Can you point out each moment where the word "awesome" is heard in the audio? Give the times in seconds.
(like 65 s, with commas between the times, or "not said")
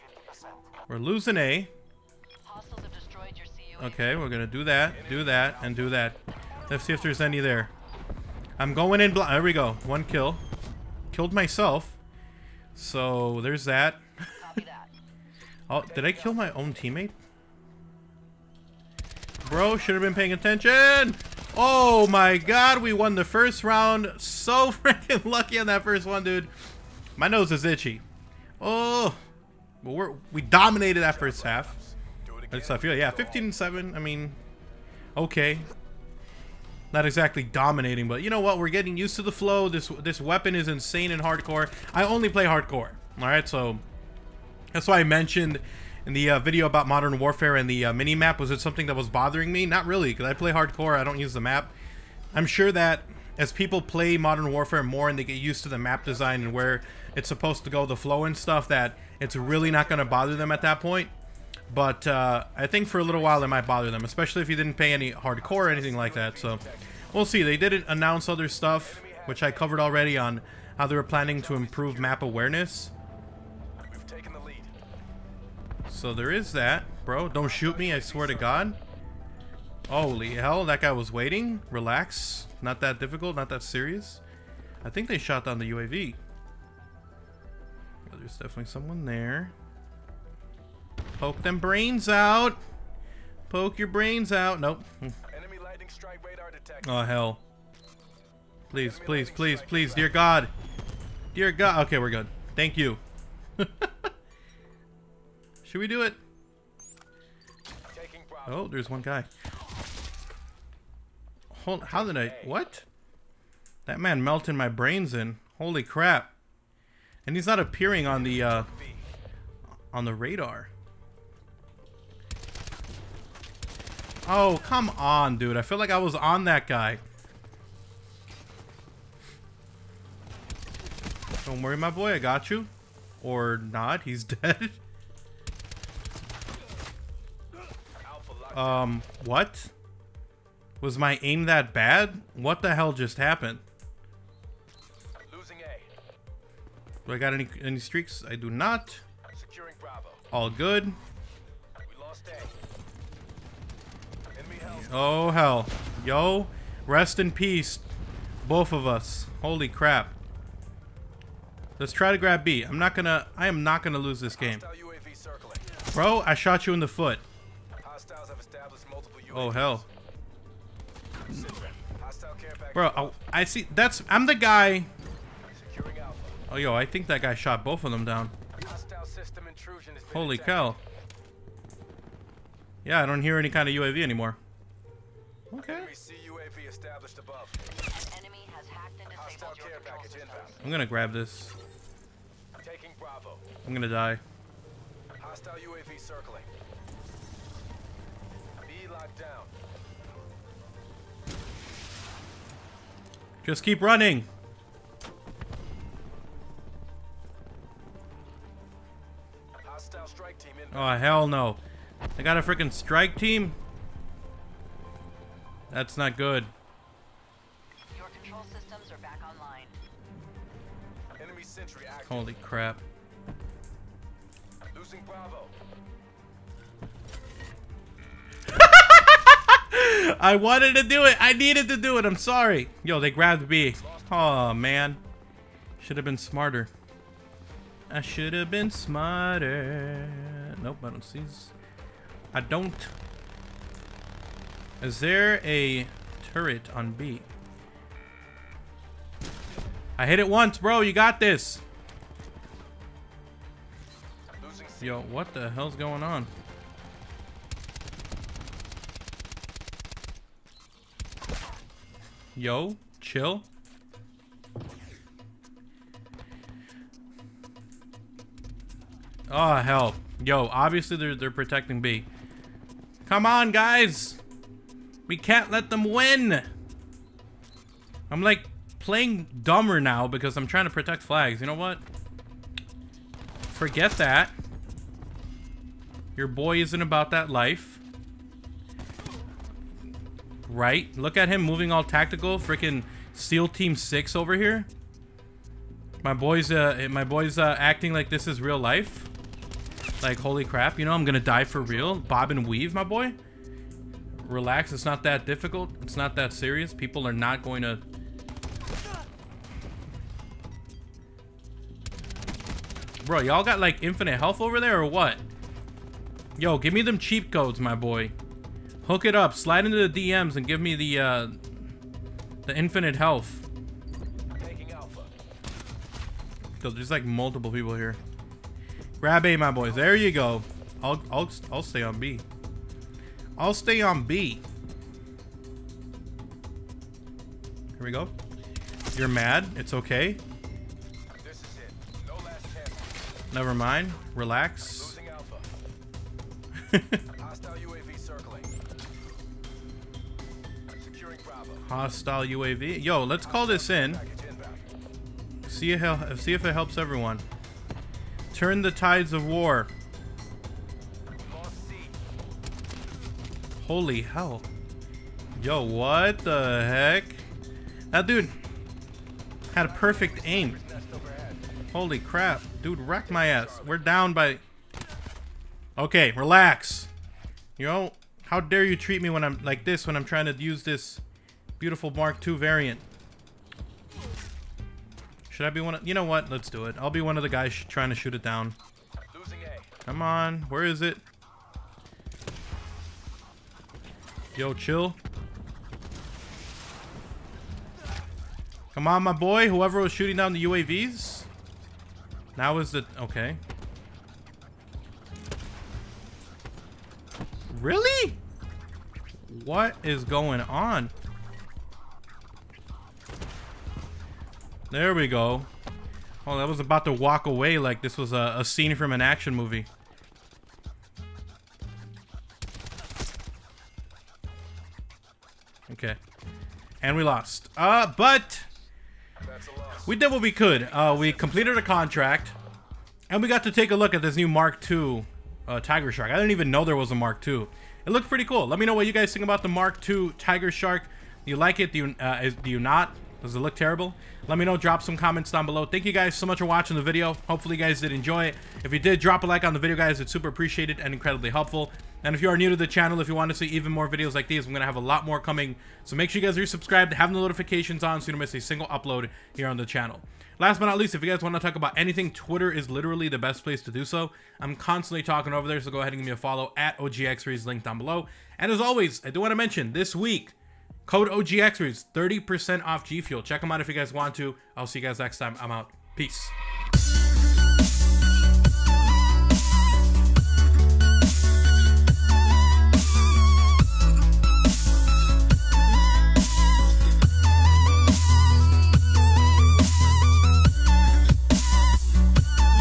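not said.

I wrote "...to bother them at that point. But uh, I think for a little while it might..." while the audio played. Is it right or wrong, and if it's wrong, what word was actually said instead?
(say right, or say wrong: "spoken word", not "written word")
right.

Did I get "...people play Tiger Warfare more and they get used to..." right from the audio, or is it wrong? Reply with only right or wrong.
wrong.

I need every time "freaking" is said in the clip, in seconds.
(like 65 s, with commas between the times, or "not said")
24 s, 292 s.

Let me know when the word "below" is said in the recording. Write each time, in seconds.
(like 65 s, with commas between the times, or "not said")
445 s, 467 s.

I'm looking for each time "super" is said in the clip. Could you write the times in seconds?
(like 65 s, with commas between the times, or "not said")
450 s.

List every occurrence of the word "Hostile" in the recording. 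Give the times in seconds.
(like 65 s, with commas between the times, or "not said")
195 s, 351 s.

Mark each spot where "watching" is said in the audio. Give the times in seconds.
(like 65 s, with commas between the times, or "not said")
446 s.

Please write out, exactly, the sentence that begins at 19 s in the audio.
Bro, should have been paying attention!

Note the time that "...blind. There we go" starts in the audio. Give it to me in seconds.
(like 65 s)
9 s.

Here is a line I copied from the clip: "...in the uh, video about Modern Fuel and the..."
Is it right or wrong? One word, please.
wrong.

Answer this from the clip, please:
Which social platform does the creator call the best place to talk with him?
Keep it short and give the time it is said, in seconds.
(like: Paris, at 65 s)
Twitter, at 462 s.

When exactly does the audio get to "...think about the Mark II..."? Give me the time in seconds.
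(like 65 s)
439 s.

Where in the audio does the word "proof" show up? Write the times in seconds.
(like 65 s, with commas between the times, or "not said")
not said.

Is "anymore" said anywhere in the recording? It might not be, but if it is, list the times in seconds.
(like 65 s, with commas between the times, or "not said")
184 s.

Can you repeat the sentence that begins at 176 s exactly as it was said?
Oh yo, I think that guy shot both of them down.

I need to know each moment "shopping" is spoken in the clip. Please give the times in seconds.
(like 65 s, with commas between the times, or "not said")
not said.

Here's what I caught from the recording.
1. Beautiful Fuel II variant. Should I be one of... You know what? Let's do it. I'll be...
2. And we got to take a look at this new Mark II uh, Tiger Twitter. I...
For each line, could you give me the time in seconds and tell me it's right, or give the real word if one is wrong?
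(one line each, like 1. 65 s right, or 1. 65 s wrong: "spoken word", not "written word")
1. 381 s wrong: "Mark", not "Fuel"
2. 433 s wrong: "Shark", not "Twitter".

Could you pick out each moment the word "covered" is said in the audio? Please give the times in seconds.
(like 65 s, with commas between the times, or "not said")
69 s.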